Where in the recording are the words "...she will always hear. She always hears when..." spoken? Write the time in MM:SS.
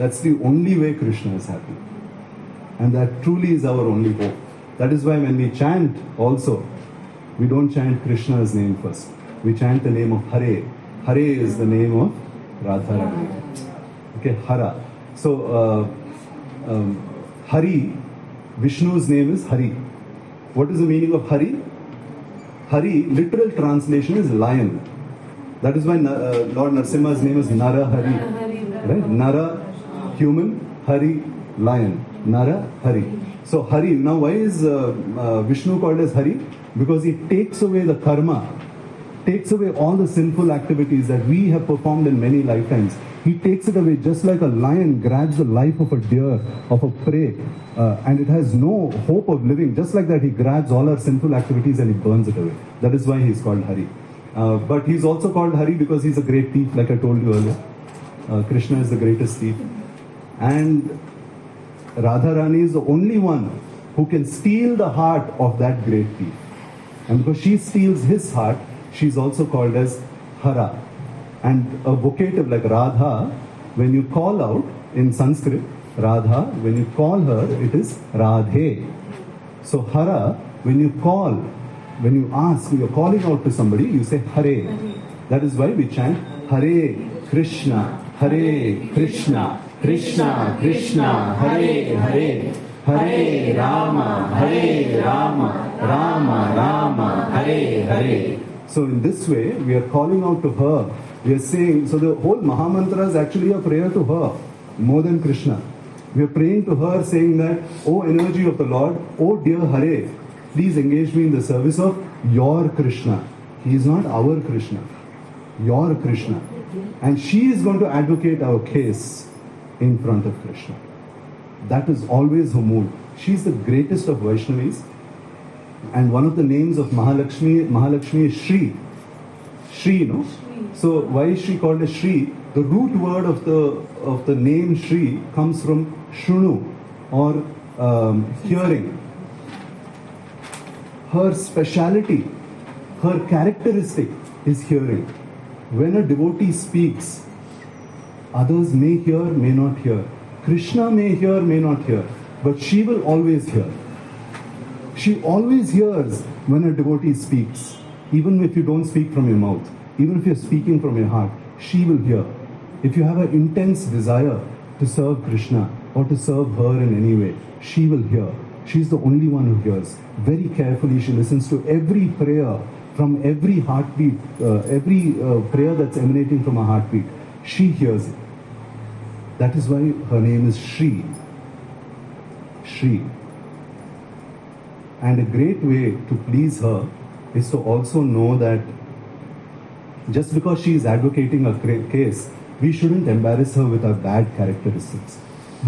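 02:32.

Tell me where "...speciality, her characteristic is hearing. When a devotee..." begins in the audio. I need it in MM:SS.
02:21.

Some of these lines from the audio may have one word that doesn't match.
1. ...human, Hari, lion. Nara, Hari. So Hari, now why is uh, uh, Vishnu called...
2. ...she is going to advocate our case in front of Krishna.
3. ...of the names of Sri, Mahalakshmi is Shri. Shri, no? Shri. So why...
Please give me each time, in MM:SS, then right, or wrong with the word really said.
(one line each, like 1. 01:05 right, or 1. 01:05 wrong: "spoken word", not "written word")
1. 00:30 right
2. 01:57 right
3. 02:06 wrong: "Mahalakshmi", not "Sri".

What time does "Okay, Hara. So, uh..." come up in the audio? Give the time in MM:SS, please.
00:14.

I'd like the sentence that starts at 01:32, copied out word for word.
Hare Rama, Hare Rama, Rama Rama, Hare Hare.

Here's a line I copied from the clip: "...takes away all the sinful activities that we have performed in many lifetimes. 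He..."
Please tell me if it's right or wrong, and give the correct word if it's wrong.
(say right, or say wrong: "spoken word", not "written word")
right.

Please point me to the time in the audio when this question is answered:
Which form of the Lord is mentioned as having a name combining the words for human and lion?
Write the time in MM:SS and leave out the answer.
00:26.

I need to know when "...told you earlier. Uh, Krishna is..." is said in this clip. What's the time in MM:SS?
00:56.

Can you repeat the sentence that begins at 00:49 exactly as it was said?
Just like that, he grabs all our sinful activities and he burns it away.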